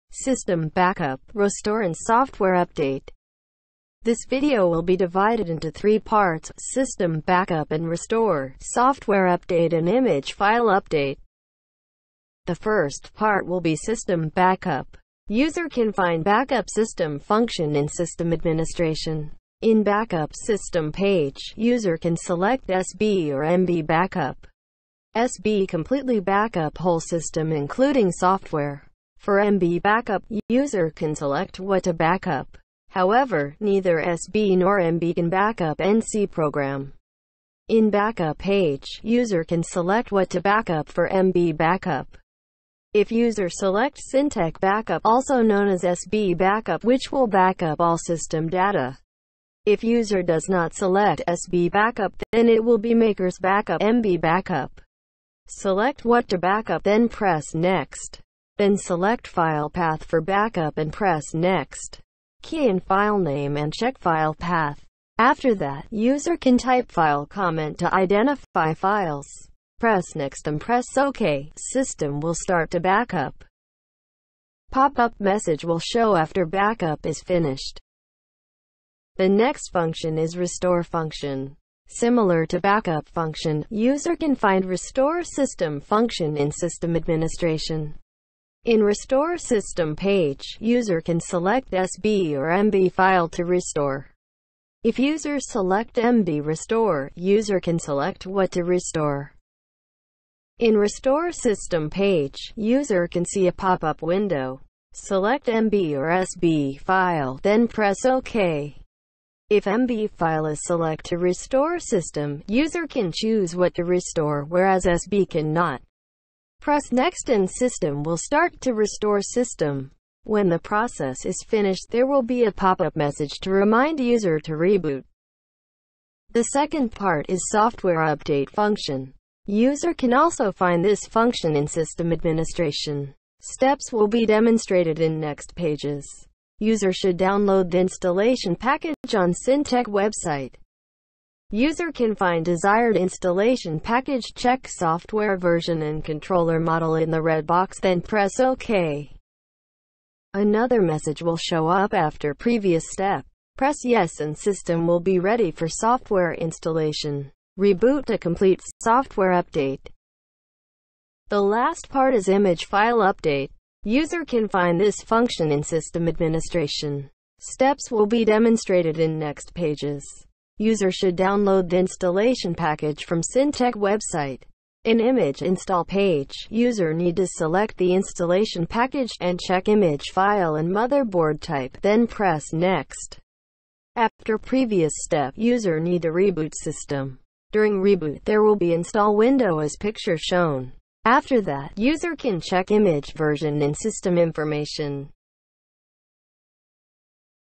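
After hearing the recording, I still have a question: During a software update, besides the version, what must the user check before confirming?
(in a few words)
controller model.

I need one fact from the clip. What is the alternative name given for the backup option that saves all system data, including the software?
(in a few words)
Syntec Backup.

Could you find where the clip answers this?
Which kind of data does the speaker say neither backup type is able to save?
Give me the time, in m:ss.
0:35.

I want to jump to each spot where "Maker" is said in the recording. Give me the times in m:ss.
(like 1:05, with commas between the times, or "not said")
0:52.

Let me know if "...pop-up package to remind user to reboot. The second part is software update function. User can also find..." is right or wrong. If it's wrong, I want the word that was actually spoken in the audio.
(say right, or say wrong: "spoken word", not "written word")
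wrong: "message", not "package".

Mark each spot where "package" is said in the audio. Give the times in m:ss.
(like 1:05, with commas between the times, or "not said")
2:18, 2:23, 2:52, 2:58.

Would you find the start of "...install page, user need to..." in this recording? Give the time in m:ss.
2:55.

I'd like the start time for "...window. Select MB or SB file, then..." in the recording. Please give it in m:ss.
1:44.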